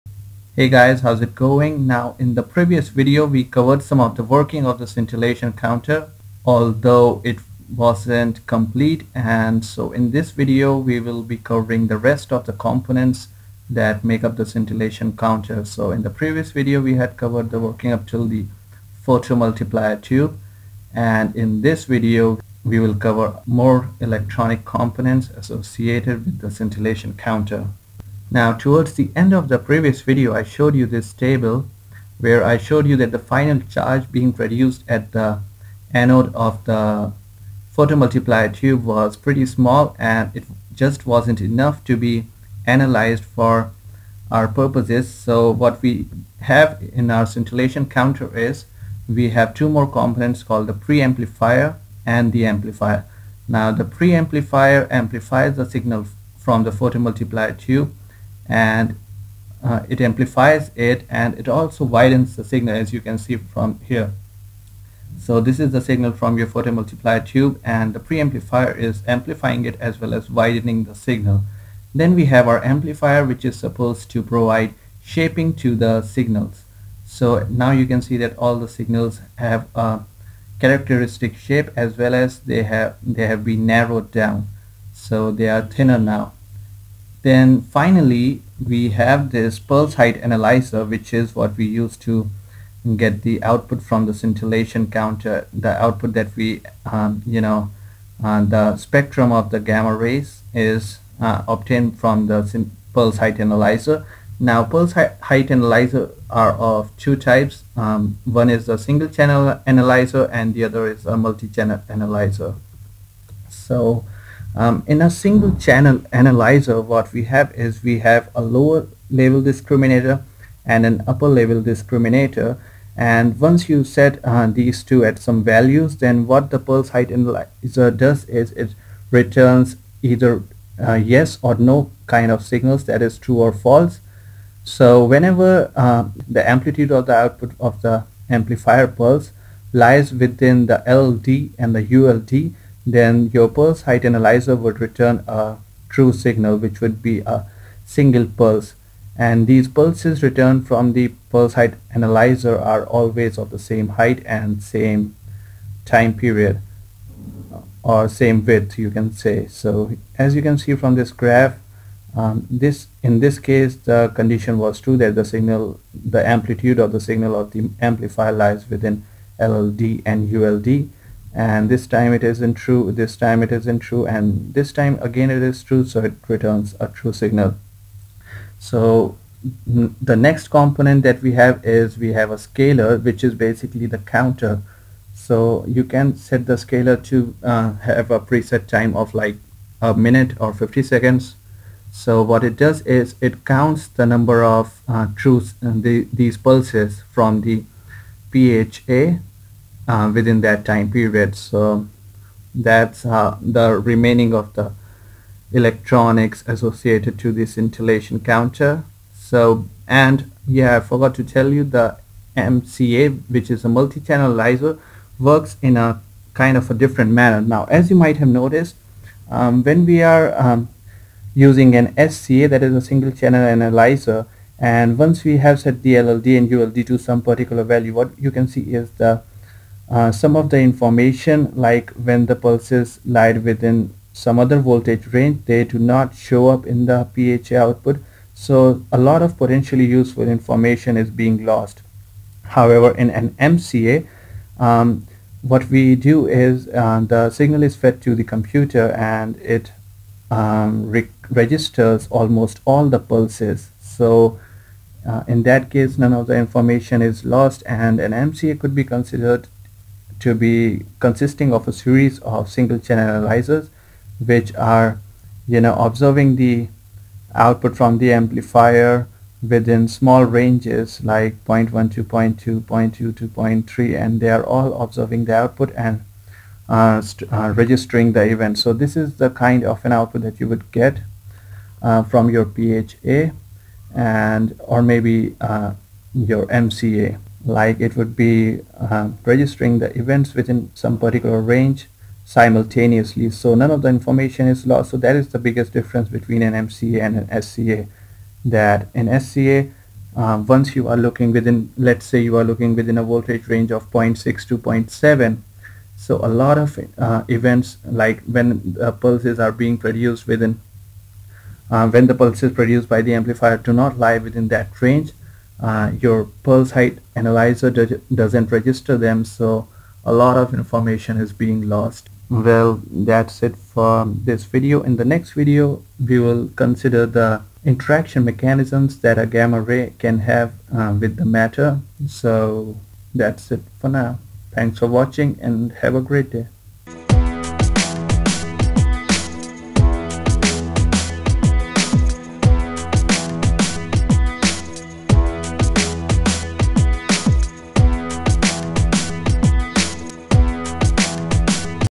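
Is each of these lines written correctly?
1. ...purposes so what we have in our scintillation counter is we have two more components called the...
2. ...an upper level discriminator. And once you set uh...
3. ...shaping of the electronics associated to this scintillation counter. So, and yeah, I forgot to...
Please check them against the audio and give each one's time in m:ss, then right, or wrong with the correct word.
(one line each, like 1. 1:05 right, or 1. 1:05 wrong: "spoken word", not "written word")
1. 0:44 right
2. 2:00 right
3. 3:23 wrong: "remaining", not "shaping".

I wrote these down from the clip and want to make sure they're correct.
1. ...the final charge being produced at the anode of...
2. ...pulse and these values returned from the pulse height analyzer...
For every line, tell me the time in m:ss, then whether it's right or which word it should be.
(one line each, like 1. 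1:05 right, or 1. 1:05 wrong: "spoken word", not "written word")
1. 0:33 right
2. 2:28 wrong: "pulses", not "values".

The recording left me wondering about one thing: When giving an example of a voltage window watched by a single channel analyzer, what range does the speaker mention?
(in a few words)
0.6 to 0.7.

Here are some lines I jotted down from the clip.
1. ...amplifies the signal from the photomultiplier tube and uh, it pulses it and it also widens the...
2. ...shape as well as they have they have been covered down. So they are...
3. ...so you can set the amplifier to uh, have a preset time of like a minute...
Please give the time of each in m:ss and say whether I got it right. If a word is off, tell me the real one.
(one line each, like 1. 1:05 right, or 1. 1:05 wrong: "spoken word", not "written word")
1. 0:54 wrong: "amplifies", not "pulses"
2. 1:21 wrong: "narrowed", not "covered"
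3. 3:05 wrong: "scaler", not "amplifier".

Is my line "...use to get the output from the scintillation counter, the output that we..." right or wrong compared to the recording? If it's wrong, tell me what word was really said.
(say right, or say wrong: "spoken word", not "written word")
right.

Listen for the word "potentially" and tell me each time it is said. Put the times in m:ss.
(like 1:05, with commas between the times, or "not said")
3:59.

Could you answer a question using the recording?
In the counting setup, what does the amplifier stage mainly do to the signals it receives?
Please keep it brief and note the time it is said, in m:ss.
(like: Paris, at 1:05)
Shaping, at 1:14.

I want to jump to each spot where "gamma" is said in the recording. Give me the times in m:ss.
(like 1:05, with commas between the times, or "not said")
1:39, 5:29.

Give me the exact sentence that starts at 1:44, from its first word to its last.
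Now pulse height analyzer are of two types.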